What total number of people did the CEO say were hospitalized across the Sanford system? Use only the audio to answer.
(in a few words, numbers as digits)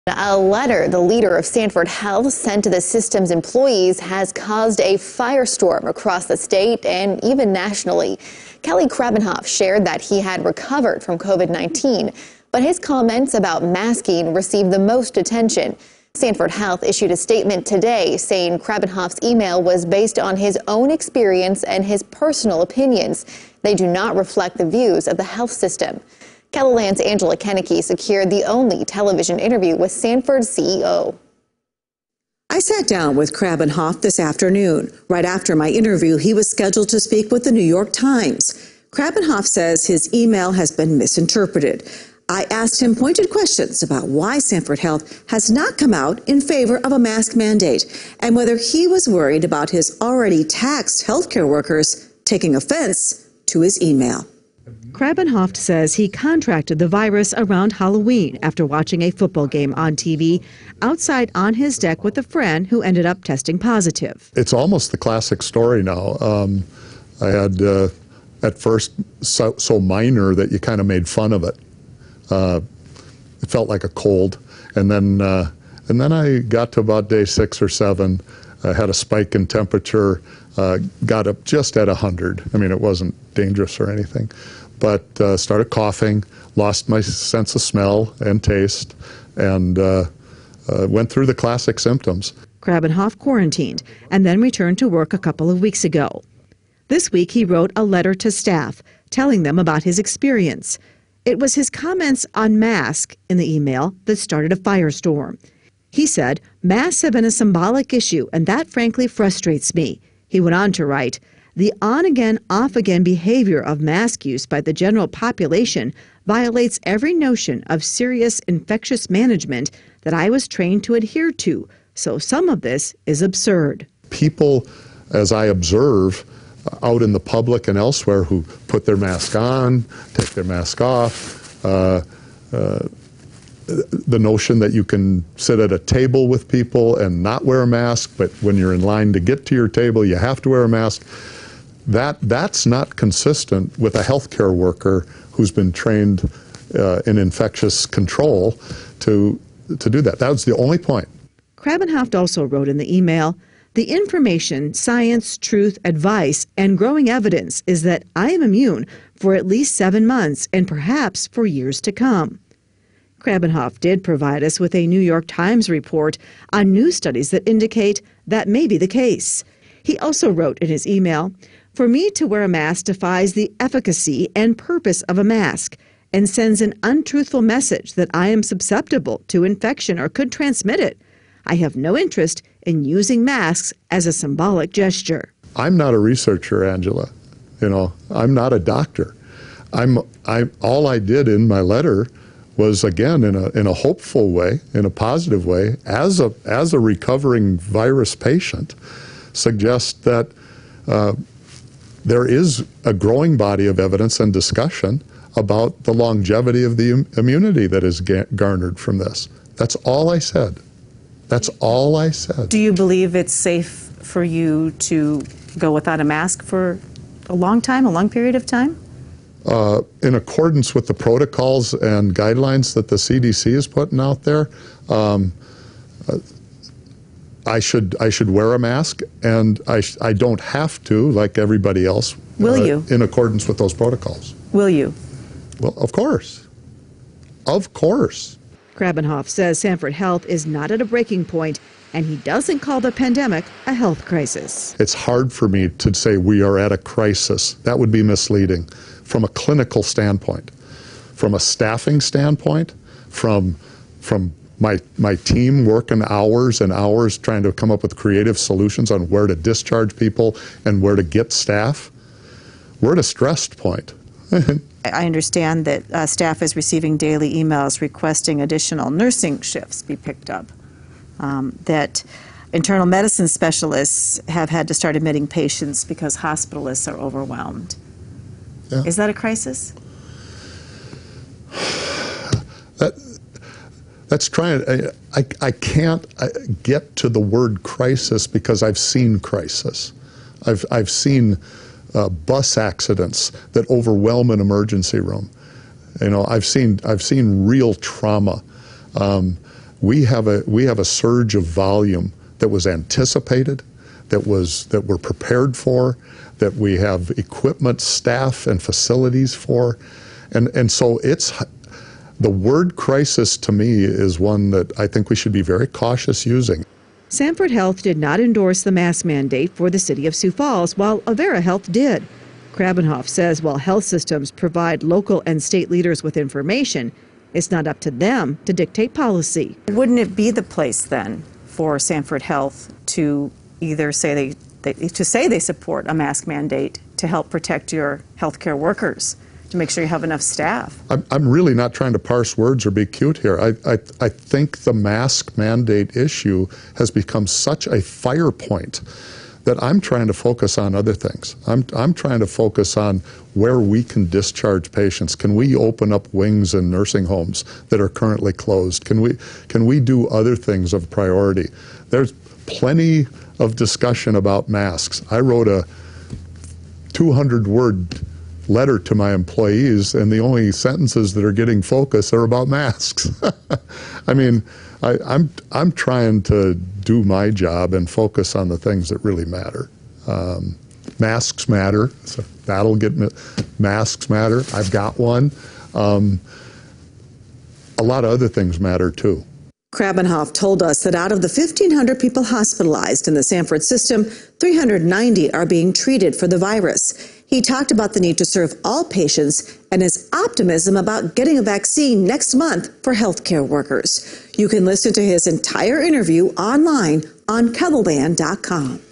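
1,500.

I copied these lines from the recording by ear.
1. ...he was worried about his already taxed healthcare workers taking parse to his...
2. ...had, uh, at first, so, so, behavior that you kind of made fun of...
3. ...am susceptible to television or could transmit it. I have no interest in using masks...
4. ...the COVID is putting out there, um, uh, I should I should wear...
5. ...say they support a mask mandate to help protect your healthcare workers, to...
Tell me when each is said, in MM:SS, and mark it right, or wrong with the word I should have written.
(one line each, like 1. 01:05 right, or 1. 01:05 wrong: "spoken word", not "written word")
1. 00:48 wrong: "offense", not "parse"
2. 01:07 wrong: "minor", not "behavior"
3. 02:58 wrong: "infection", not "television"
4. 03:42 wrong: "CDC", not "COVID"
5. 05:35 right.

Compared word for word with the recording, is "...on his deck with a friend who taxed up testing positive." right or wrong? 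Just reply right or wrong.
wrong.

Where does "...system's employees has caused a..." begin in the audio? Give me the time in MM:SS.
00:02.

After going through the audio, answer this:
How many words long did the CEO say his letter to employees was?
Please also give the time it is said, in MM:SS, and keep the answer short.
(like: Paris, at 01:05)
200, at 06:06.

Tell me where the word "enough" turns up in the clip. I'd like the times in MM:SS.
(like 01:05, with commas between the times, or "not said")
05:40.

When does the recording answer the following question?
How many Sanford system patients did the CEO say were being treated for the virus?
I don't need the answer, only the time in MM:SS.
06:34.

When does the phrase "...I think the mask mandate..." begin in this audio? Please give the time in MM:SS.
05:43.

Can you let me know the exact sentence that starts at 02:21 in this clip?
That that's not consistent with a healthcare worker who's been trained uh, in infectious control to to do that.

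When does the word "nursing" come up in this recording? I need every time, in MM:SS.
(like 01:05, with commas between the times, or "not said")
04:28, 05:56.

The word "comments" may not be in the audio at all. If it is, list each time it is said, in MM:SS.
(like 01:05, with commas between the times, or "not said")
00:12, 01:41.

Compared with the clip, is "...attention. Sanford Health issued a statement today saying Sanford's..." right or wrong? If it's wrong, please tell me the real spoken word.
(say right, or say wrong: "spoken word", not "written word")
wrong: "Krabbenhoft", not "Sanford".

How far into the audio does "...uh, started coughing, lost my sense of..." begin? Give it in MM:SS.
01:25.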